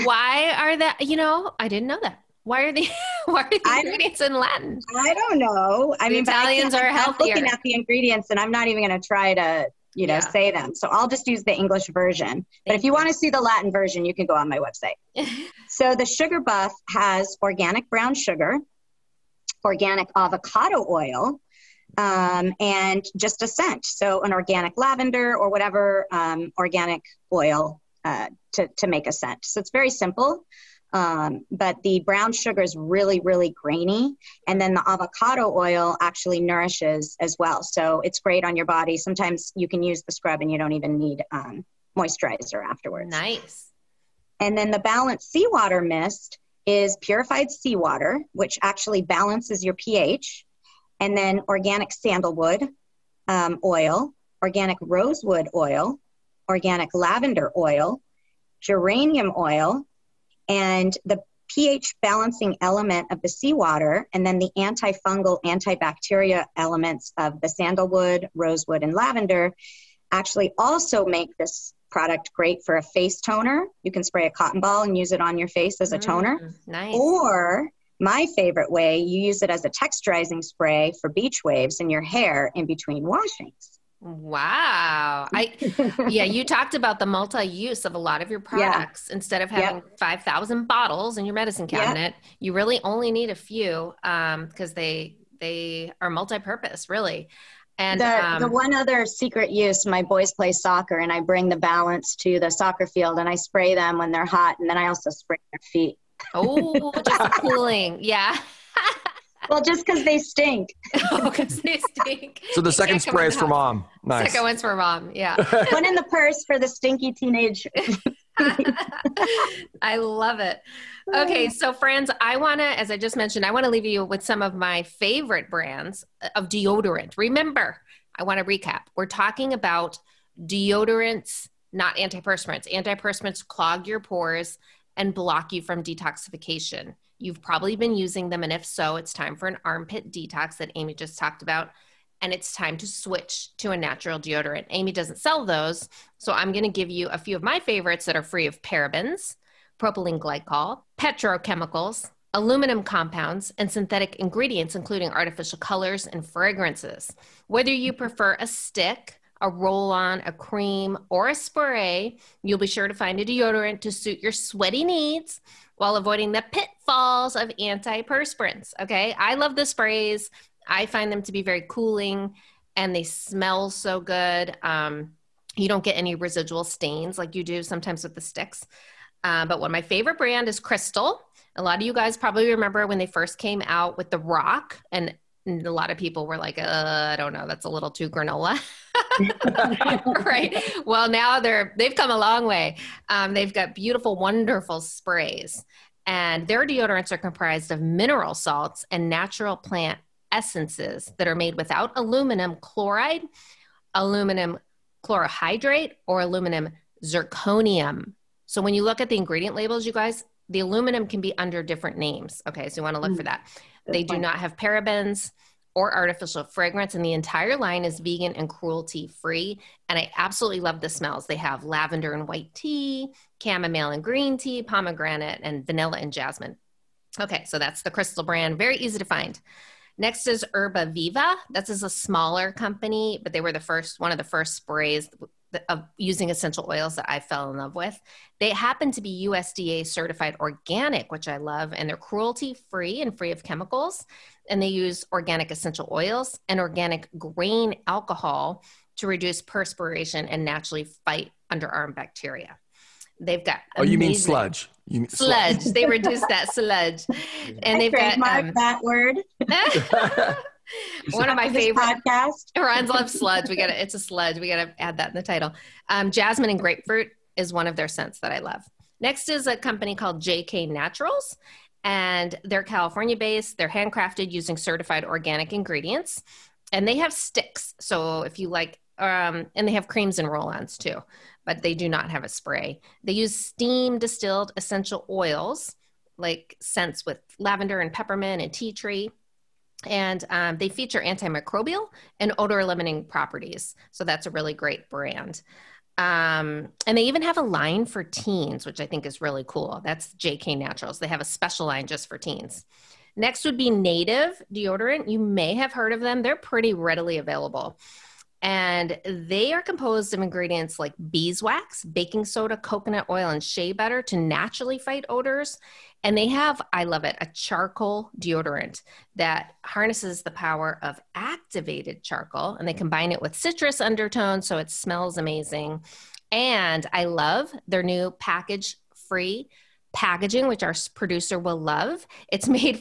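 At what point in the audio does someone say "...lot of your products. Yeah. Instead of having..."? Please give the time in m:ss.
1:27.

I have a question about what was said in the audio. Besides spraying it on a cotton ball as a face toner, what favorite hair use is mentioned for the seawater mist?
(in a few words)
texturizing spray.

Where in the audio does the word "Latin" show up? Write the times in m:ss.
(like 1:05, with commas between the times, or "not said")
0:04, 0:13.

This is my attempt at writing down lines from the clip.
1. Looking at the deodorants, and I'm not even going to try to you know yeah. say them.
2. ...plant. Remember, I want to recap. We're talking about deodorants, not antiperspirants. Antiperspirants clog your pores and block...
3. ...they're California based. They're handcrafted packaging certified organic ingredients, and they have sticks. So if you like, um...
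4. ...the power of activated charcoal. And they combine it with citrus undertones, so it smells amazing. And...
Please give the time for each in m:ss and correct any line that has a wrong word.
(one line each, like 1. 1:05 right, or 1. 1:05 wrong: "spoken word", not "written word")
1. 0:07 wrong: "ingredients", not "deodorants"
2. 2:06 wrong: "deodorant", not "plant"
3. 4:32 wrong: "using", not "packaging"
4. 5:20 right.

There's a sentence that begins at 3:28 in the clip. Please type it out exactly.
So when you look at the ingredient labels, you guys, the aluminum can be under different names.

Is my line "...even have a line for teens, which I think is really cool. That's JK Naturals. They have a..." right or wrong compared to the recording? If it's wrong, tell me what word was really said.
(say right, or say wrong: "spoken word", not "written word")
right.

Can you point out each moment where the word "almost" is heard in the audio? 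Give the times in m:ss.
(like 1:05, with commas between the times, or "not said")
not said.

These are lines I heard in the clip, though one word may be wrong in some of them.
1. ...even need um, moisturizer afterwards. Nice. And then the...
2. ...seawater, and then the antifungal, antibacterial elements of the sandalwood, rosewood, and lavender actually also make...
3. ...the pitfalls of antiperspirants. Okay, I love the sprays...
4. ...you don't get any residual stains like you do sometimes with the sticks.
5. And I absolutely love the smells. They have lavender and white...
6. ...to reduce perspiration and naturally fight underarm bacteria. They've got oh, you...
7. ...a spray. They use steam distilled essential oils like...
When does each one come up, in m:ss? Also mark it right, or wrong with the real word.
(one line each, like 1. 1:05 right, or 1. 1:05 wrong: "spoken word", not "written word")
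1. 0:40 right
2. 1:03 right
3. 2:46 right
4. 2:55 right
5. 3:39 right
6. 4:08 right
7. 4:42 right.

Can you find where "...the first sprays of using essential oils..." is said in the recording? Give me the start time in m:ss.
3:54.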